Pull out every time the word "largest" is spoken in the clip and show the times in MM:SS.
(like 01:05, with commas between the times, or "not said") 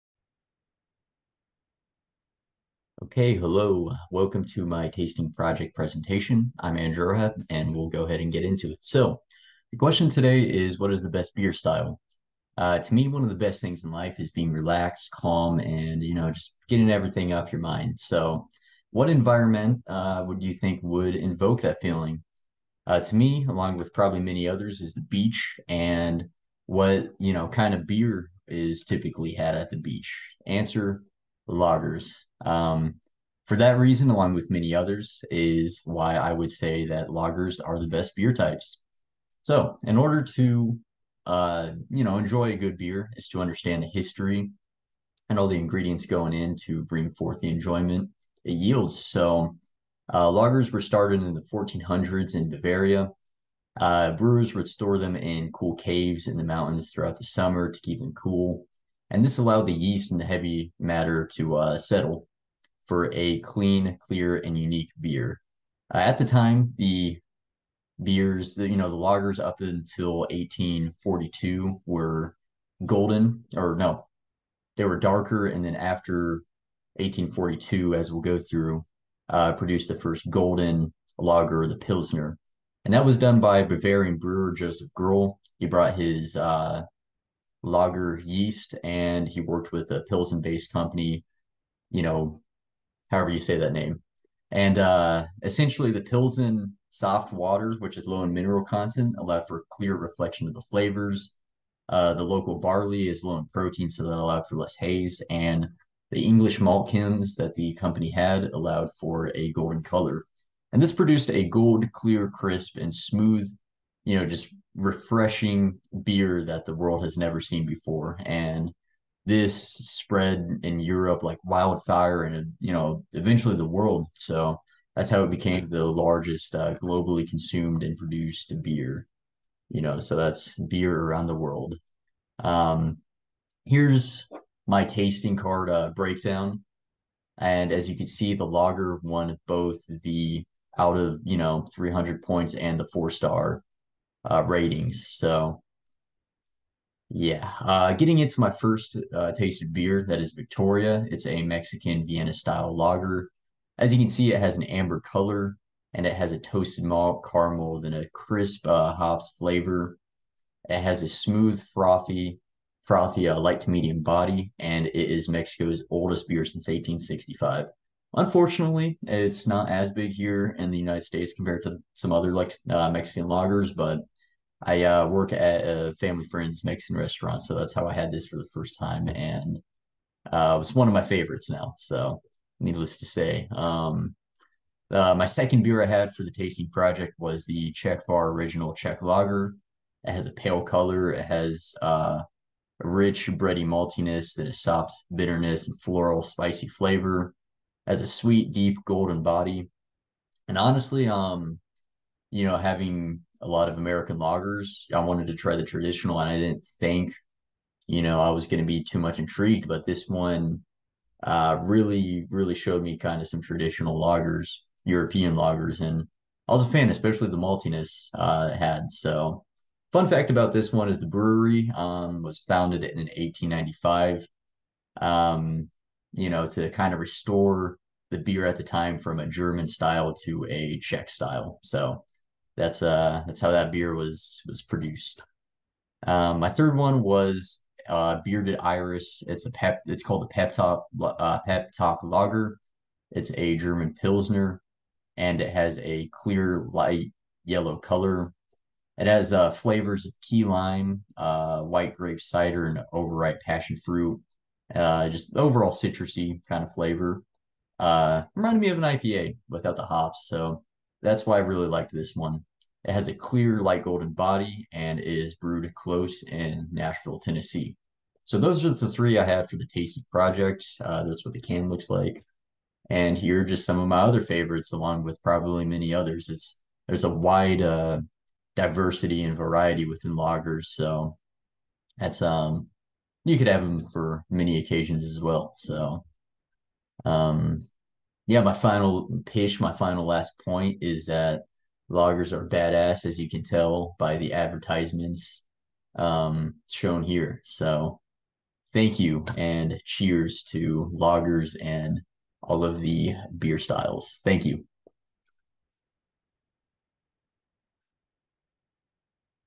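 02:05.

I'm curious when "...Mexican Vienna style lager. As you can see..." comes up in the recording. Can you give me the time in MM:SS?
02:31.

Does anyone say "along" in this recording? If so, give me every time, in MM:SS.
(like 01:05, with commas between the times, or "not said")
00:23, 00:34, 04:34.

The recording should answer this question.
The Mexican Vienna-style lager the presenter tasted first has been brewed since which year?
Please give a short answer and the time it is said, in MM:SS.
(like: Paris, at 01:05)
1865, at 02:46.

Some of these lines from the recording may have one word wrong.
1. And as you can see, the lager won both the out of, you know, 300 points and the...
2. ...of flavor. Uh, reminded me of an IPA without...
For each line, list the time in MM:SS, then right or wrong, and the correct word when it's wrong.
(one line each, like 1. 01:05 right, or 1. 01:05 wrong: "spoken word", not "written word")
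1. 02:17 right
2. 04:16 right.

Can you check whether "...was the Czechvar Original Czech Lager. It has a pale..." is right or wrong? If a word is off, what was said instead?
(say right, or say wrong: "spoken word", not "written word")
right.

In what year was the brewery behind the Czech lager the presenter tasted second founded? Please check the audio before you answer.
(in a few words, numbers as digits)
1895.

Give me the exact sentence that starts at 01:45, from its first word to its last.
And the English malt kilns that the company had allowed for a golden color.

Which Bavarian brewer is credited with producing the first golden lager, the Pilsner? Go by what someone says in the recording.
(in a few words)
Joseph Groll.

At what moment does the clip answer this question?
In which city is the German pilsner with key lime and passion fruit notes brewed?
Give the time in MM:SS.
04:26.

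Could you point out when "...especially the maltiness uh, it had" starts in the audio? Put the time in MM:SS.
03:36.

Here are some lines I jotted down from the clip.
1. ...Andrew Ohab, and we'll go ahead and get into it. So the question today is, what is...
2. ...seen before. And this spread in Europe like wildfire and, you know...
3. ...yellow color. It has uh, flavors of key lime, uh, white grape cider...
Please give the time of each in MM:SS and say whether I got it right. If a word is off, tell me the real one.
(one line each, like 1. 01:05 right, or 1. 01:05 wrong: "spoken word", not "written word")
1. 00:06 right
2. 01:57 right
3. 04:07 right.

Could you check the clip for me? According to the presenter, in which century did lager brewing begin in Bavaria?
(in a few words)
1400s.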